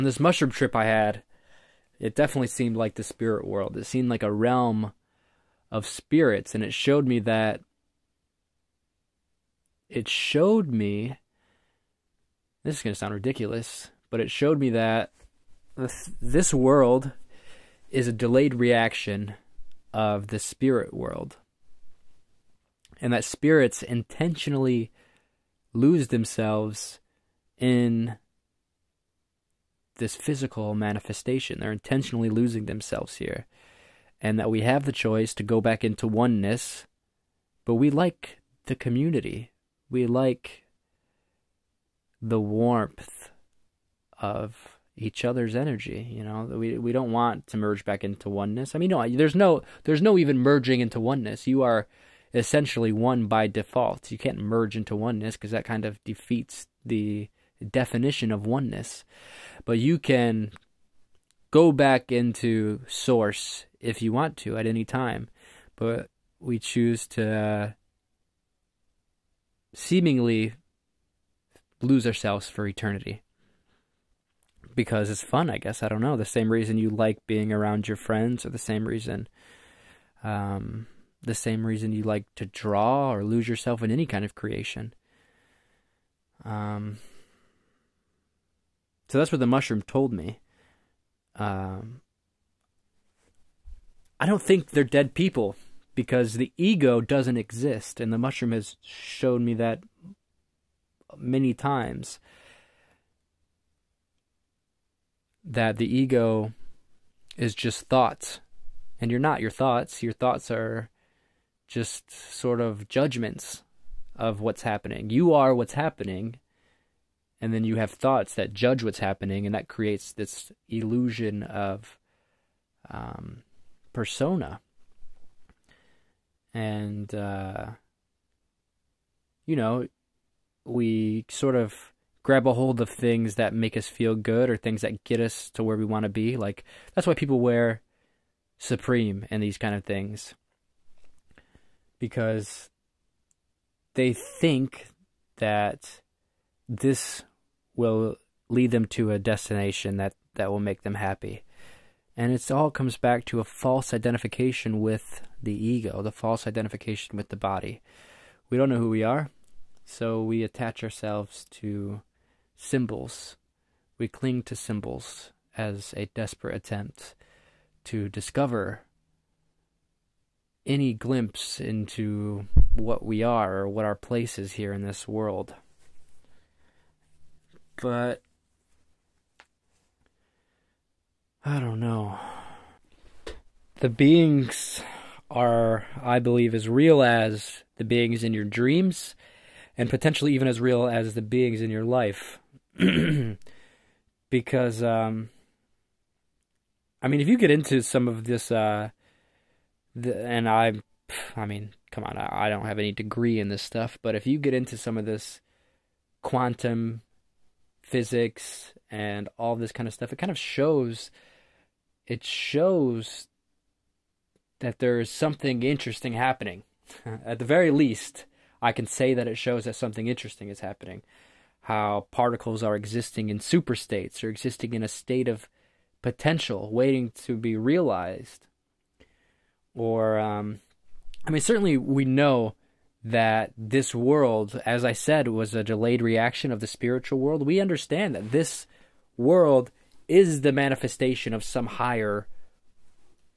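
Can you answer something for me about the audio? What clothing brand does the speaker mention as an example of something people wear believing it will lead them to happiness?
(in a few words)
Supreme.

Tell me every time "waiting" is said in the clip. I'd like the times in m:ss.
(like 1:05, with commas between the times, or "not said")
3:46.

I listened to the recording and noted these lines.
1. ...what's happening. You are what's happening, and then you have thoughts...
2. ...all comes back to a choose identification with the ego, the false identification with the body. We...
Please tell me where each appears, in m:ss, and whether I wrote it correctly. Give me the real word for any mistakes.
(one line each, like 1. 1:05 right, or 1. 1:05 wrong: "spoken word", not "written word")
1. 1:54 right
2. 2:32 wrong: "false", not "choose".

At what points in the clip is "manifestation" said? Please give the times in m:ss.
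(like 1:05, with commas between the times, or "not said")
0:30, 4:00.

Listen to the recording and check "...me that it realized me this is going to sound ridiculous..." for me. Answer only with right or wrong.
wrong.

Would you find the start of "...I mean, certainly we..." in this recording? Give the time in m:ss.
3:51.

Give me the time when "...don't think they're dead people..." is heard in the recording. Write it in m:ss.
1:34.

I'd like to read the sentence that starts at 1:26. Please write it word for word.
Um, so that's what the mushroom told me.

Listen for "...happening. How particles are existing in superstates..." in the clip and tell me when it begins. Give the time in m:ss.
3:40.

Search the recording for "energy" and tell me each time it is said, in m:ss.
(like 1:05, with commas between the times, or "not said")
0:45.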